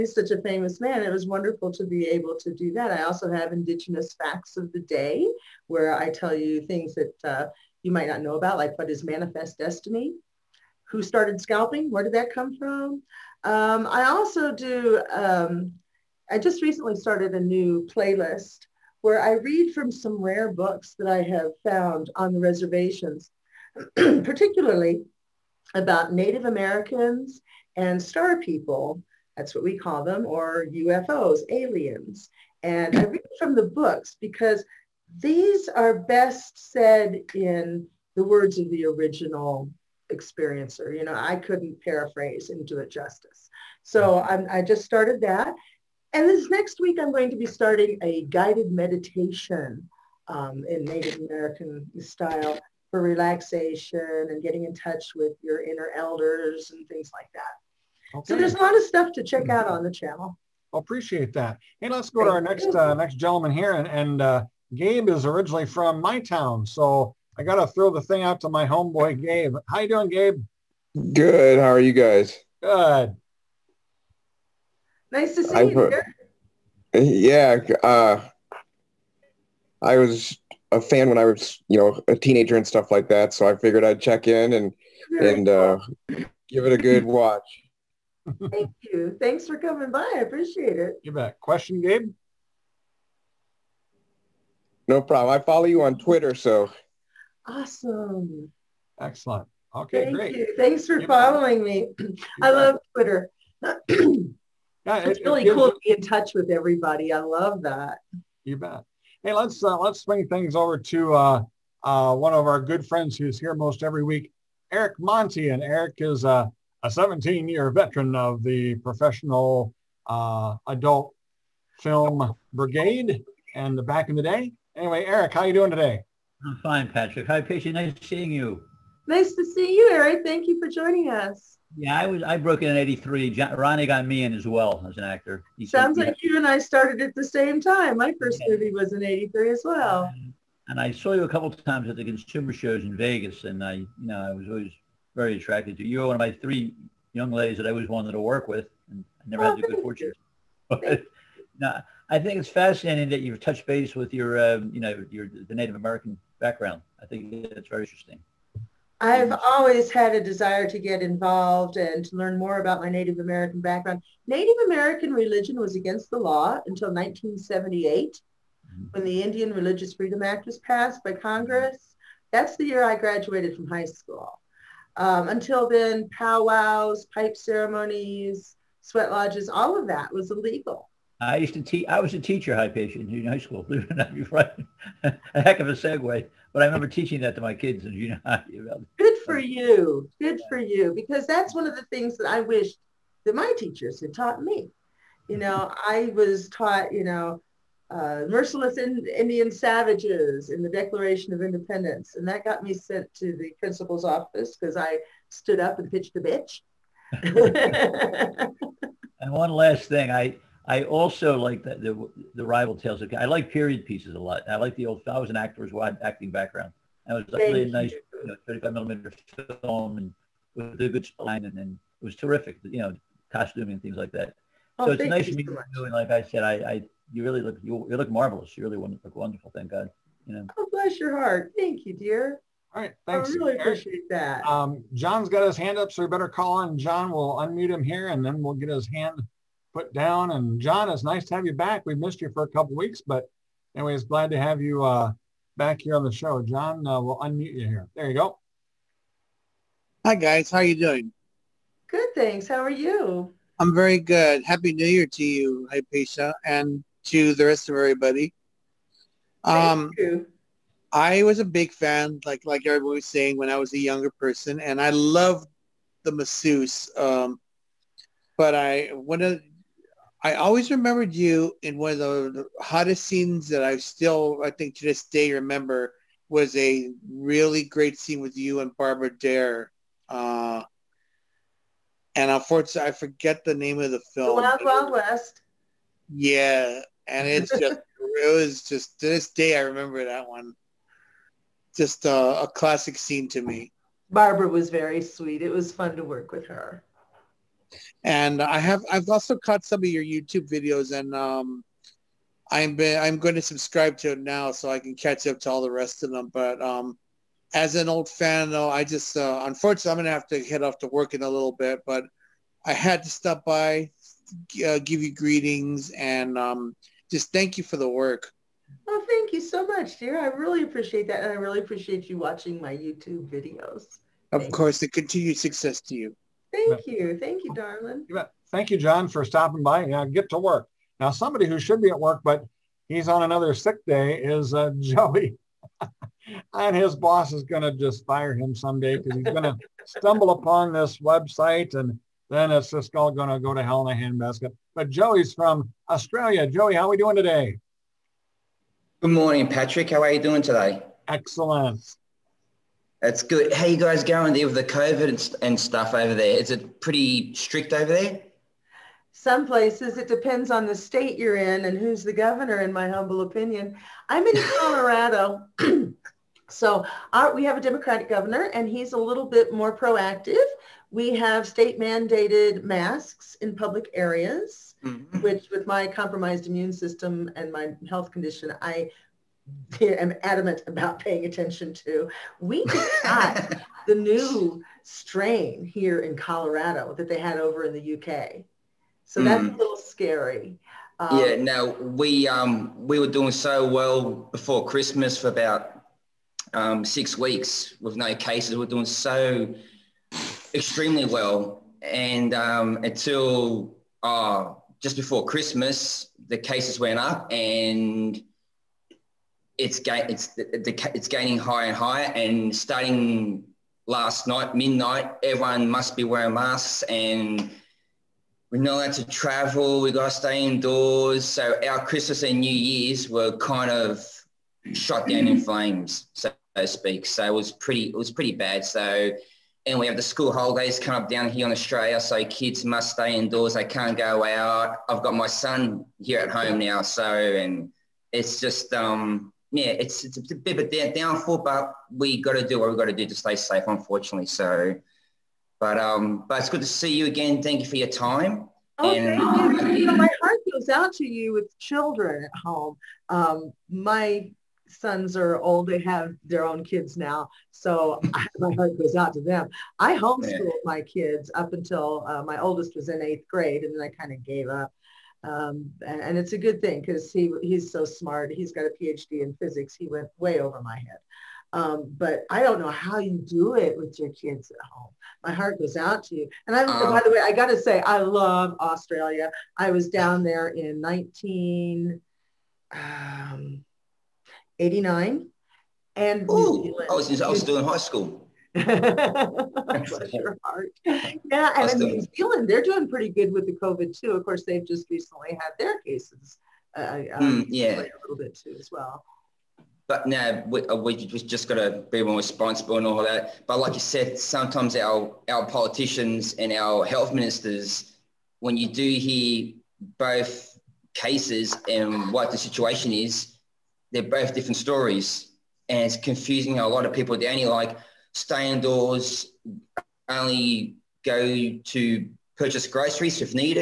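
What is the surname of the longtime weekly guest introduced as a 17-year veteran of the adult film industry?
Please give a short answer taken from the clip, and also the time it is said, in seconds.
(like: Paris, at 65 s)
Monti, at 114 s.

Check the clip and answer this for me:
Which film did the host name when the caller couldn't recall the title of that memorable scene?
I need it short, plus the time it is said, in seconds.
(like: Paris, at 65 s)
The Wild Wild West, at 284 s.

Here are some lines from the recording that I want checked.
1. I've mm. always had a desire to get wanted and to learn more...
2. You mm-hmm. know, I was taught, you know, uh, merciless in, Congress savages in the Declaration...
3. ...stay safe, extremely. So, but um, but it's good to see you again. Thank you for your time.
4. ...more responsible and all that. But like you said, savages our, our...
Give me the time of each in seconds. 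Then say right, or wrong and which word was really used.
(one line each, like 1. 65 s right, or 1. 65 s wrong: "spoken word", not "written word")
1. 158 s wrong: "involved", not "wanted"
2. 195 s wrong: "Indian", not "Congress"
3. 443 s wrong: "unfortunately", not "extremely"
4. 502 s wrong: "sometimes", not "savages".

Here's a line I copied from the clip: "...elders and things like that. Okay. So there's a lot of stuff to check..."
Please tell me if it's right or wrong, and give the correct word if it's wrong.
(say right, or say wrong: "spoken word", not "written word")
right.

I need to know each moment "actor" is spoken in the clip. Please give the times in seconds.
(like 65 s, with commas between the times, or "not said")
135 s, 215 s.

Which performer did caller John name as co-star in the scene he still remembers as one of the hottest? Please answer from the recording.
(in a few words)
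Barbara Dare.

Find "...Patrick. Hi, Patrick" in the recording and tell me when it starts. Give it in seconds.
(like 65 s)
126 s.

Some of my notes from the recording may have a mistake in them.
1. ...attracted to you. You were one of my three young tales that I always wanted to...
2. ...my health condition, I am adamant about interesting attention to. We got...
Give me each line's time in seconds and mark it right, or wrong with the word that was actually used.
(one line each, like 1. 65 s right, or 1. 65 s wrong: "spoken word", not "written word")
1. 145 s wrong: "ladies", not "tales"
2. 377 s wrong: "paying", not "interesting".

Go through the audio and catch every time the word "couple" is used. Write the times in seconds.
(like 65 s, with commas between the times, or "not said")
141 s, 242 s.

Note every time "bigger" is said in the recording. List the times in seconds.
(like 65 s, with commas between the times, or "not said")
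not said.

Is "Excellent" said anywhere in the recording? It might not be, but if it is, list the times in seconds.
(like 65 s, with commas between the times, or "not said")
98 s, 351 s.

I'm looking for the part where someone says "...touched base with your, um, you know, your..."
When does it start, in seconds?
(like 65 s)
153 s.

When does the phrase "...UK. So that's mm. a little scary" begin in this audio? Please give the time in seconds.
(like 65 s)
387 s.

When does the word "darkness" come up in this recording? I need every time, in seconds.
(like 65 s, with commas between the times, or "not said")
not said.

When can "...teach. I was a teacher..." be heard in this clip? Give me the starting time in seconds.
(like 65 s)
181 s.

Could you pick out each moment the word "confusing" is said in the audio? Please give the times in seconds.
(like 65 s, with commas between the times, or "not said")
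515 s.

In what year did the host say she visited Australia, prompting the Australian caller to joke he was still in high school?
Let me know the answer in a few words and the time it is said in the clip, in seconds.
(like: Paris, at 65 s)
1989, at 480 s.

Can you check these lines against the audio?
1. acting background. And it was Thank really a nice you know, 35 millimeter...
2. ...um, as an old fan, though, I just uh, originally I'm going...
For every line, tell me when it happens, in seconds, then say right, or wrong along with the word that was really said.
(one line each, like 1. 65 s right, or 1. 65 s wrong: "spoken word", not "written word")
1. 216 s right
2. 306 s wrong: "unfortunately", not "originally".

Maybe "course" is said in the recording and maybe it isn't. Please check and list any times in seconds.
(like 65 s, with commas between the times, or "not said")
324 s, 494 s.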